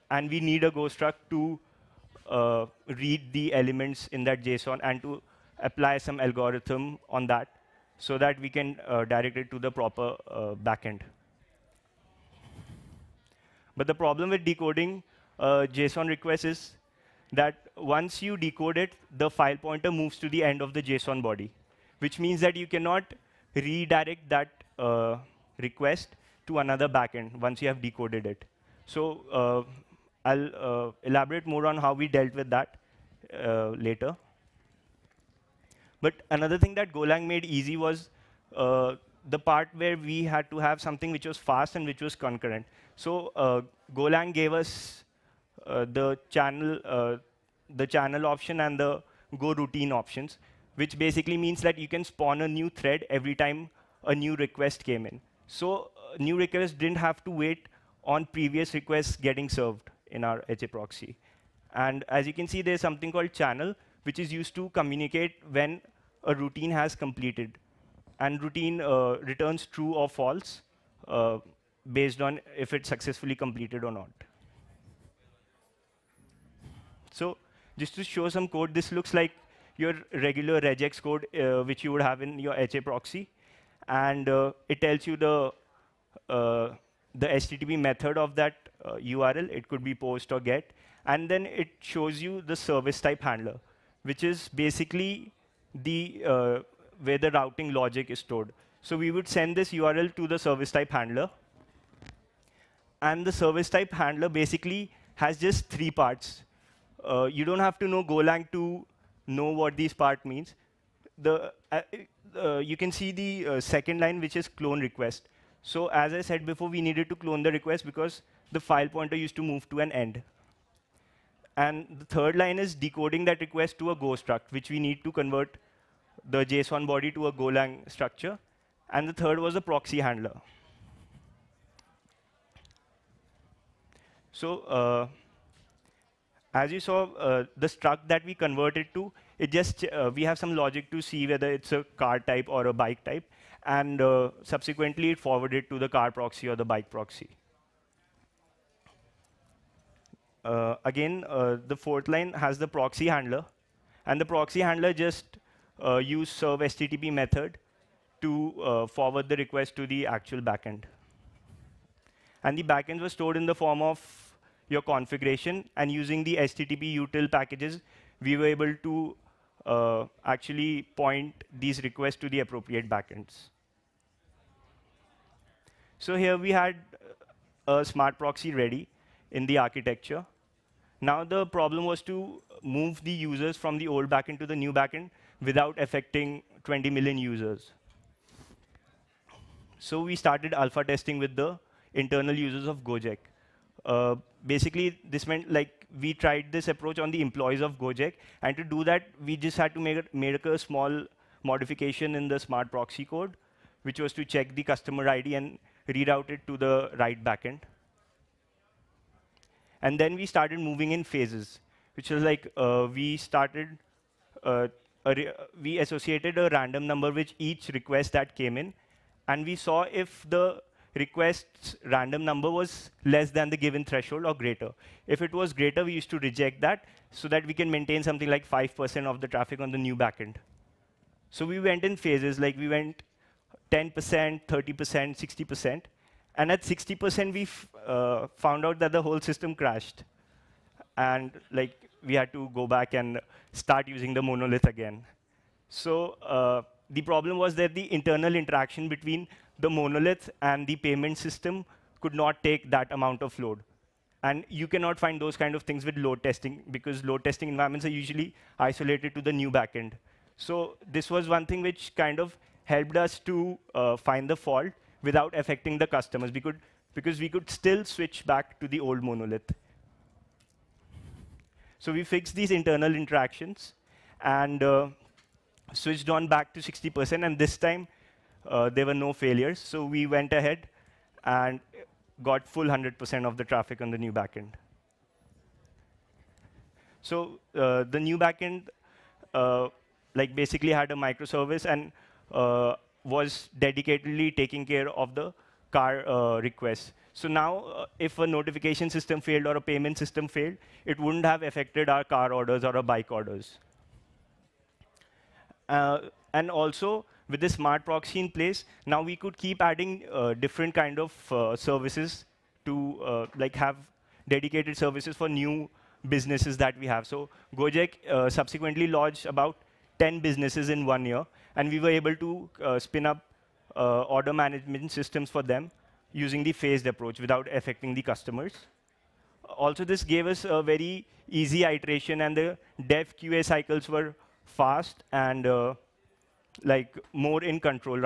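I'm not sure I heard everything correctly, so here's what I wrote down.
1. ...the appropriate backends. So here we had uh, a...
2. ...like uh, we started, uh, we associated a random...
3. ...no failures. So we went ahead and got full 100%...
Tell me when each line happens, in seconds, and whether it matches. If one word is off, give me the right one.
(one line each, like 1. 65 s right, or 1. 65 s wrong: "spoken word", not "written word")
1. 172 s right
2. 212 s right
3. 278 s right.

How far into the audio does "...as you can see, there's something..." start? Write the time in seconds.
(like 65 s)
62 s.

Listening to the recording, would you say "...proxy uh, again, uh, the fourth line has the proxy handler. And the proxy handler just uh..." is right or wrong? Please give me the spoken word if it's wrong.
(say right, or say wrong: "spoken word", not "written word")
right.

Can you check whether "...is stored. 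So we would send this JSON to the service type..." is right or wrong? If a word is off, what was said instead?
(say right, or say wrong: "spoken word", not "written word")
wrong: "URL", not "JSON".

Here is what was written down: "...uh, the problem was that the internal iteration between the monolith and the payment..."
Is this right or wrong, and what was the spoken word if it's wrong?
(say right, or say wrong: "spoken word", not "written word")
wrong: "interaction", not "iteration".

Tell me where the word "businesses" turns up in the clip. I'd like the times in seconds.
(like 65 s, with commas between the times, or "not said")
316 s, 320 s.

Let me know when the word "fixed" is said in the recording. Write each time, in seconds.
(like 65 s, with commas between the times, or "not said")
272 s.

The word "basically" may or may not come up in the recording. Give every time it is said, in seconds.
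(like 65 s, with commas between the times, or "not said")
50 s, 94 s, 104 s, 194 s, 290 s.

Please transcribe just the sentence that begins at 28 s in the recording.
So uh, I'll uh, elaborate more on how we dealt with that uh, later.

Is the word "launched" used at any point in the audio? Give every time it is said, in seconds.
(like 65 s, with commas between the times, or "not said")
318 s.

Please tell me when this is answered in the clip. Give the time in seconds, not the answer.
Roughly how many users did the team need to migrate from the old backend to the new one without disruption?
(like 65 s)
186 s.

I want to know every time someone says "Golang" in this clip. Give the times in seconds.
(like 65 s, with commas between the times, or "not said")
36 s, 43 s, 108 s, 127 s.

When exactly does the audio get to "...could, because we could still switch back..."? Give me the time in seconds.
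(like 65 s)
266 s.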